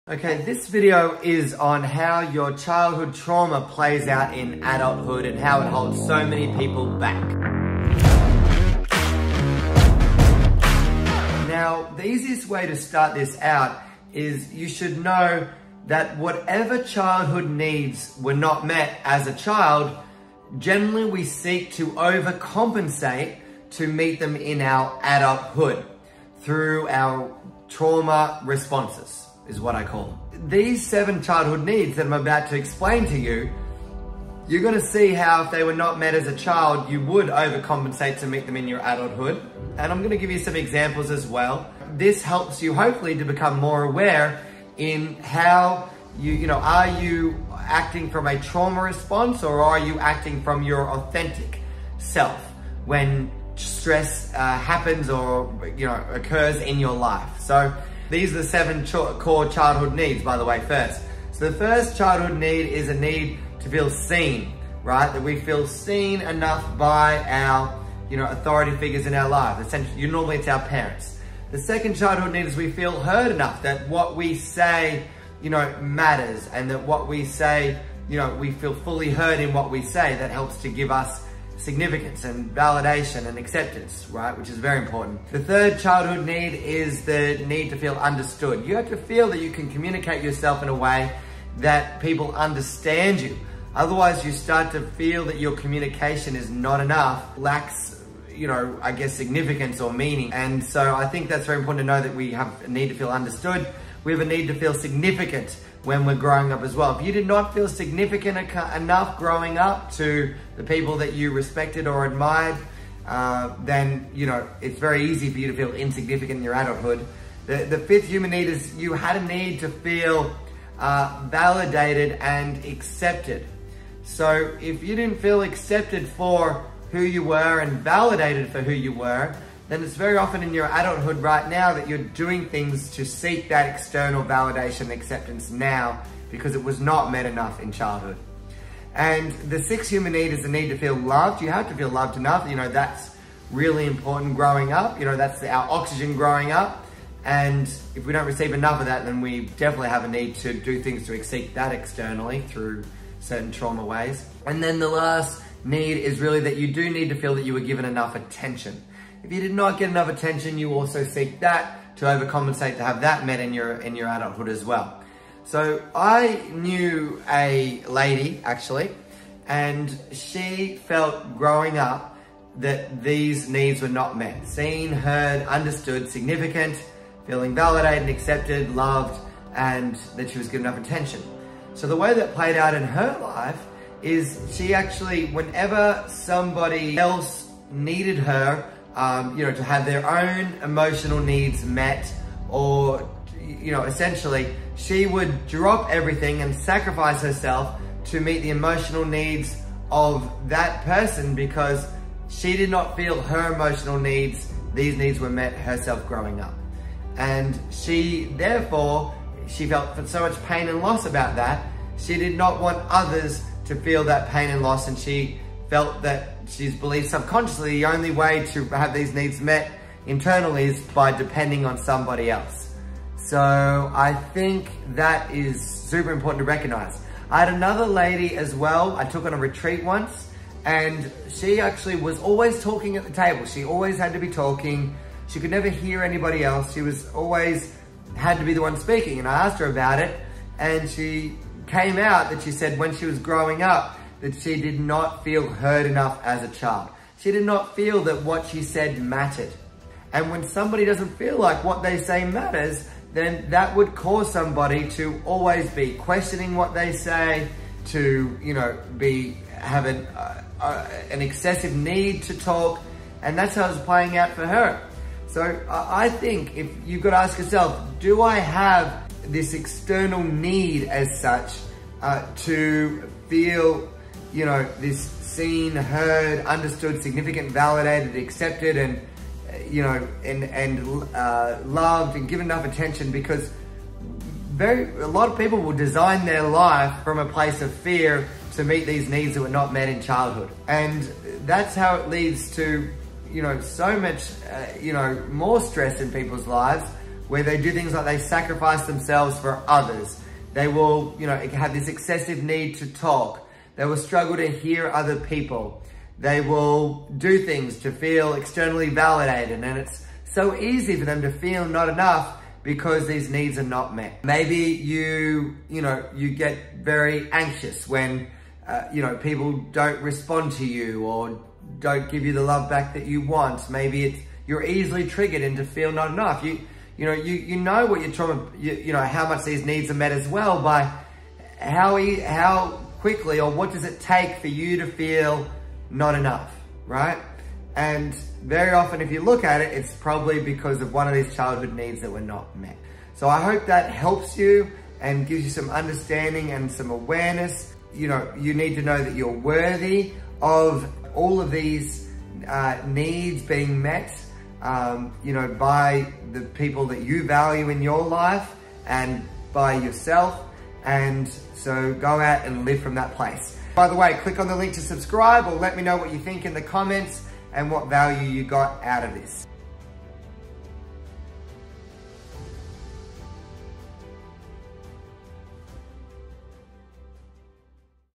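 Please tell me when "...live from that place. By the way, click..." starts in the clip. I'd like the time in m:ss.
6:02.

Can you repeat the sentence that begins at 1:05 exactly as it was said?
That we feel seen enough by our, you know, authority figures in our lives.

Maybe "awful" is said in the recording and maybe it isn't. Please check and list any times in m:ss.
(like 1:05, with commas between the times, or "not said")
not said.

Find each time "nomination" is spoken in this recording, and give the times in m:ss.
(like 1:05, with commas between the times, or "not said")
not said.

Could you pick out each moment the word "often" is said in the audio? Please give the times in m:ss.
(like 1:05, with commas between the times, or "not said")
2:10, 5:38.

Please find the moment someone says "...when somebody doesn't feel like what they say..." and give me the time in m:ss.
4:10.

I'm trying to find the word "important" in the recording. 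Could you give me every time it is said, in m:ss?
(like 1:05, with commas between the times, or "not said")
1:24, 1:41, 2:23, 3:46.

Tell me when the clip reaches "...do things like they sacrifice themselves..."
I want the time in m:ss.
4:57.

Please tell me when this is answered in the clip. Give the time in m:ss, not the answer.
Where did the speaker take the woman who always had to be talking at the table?
3:49.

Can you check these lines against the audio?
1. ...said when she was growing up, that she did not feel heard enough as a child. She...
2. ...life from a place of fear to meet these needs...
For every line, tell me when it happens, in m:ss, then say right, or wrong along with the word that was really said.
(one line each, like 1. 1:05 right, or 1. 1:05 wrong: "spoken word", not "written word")
1. 4:02 right
2. 4:46 right.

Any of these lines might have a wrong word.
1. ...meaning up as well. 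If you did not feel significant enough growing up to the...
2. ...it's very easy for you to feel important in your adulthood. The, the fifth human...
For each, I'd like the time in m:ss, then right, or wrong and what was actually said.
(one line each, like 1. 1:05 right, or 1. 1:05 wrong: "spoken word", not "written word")
1. 1:46 wrong: "growing", not "meaning"
2. 1:54 wrong: "insignificant", not "important".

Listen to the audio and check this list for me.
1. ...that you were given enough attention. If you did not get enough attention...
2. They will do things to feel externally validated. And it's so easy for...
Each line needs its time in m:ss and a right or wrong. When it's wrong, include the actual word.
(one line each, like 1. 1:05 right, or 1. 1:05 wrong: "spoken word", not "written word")
1. 2:37 right
2. 5:06 right.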